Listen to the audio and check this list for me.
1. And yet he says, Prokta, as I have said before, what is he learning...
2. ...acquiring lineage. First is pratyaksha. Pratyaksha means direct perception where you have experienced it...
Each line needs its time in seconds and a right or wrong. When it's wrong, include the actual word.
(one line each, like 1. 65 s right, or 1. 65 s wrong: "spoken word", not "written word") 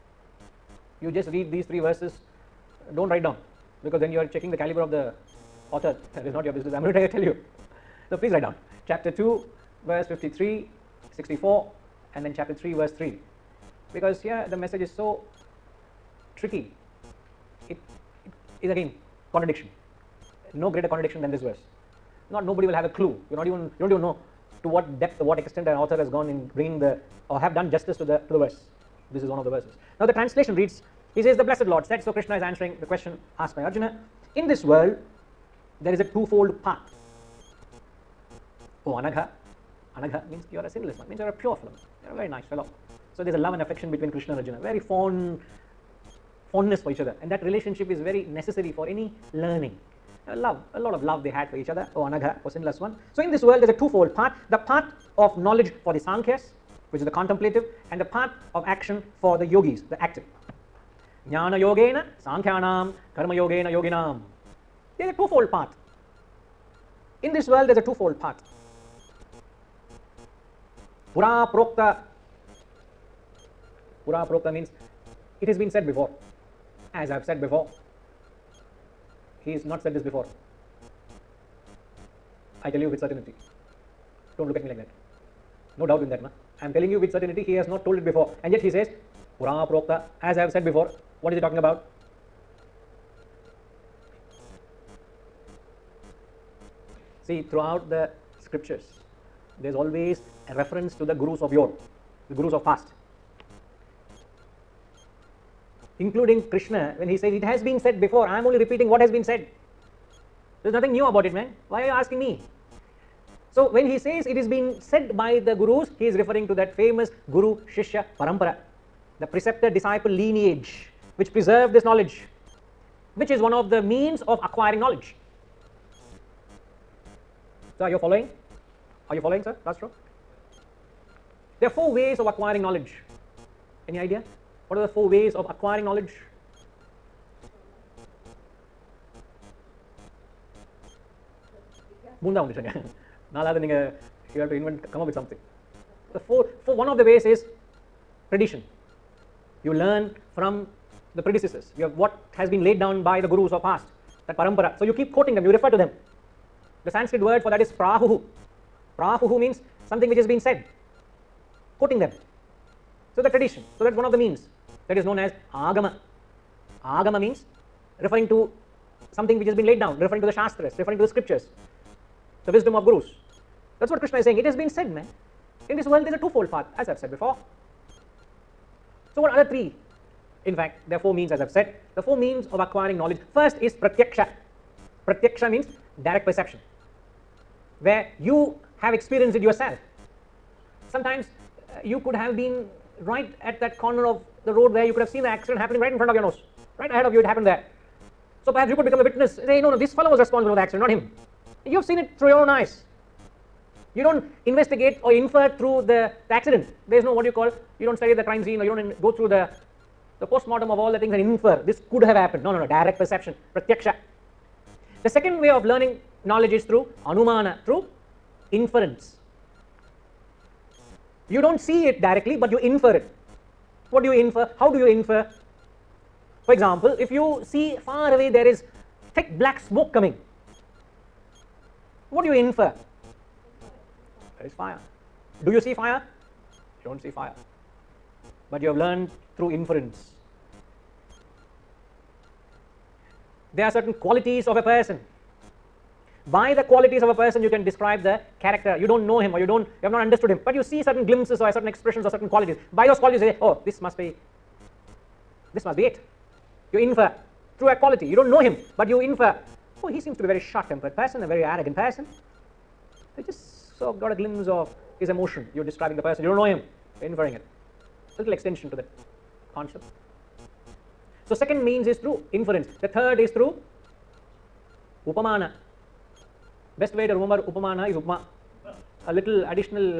1. 88 s wrong: "talking", not "learning"
2. 182 s wrong: "knowledge", not "lineage".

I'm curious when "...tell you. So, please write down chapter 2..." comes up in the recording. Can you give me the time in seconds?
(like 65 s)
7 s.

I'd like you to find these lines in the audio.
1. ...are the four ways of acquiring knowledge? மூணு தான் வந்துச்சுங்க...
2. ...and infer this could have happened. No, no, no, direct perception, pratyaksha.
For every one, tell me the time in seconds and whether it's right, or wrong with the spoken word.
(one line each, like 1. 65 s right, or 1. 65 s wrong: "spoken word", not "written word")
1. 134 s right
2. 211 s right.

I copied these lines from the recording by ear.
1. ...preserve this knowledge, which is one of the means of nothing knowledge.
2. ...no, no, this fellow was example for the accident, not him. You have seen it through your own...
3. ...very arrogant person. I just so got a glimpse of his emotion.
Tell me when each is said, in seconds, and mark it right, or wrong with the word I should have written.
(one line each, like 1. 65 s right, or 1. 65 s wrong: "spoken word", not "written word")
1. 121 s wrong: "acquiring", not "nothing"
2. 199 s wrong: "responsible", not "example"
3. 261 s right.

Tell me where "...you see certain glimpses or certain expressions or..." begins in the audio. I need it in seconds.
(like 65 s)
250 s.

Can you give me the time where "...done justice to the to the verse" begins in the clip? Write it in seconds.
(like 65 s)
27 s.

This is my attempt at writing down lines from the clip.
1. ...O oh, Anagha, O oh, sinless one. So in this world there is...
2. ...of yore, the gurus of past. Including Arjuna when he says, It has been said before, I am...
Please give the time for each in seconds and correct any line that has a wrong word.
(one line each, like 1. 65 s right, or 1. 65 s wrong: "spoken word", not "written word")
1. 51 s right
2. 101 s wrong: "Krishna", not "Arjuna".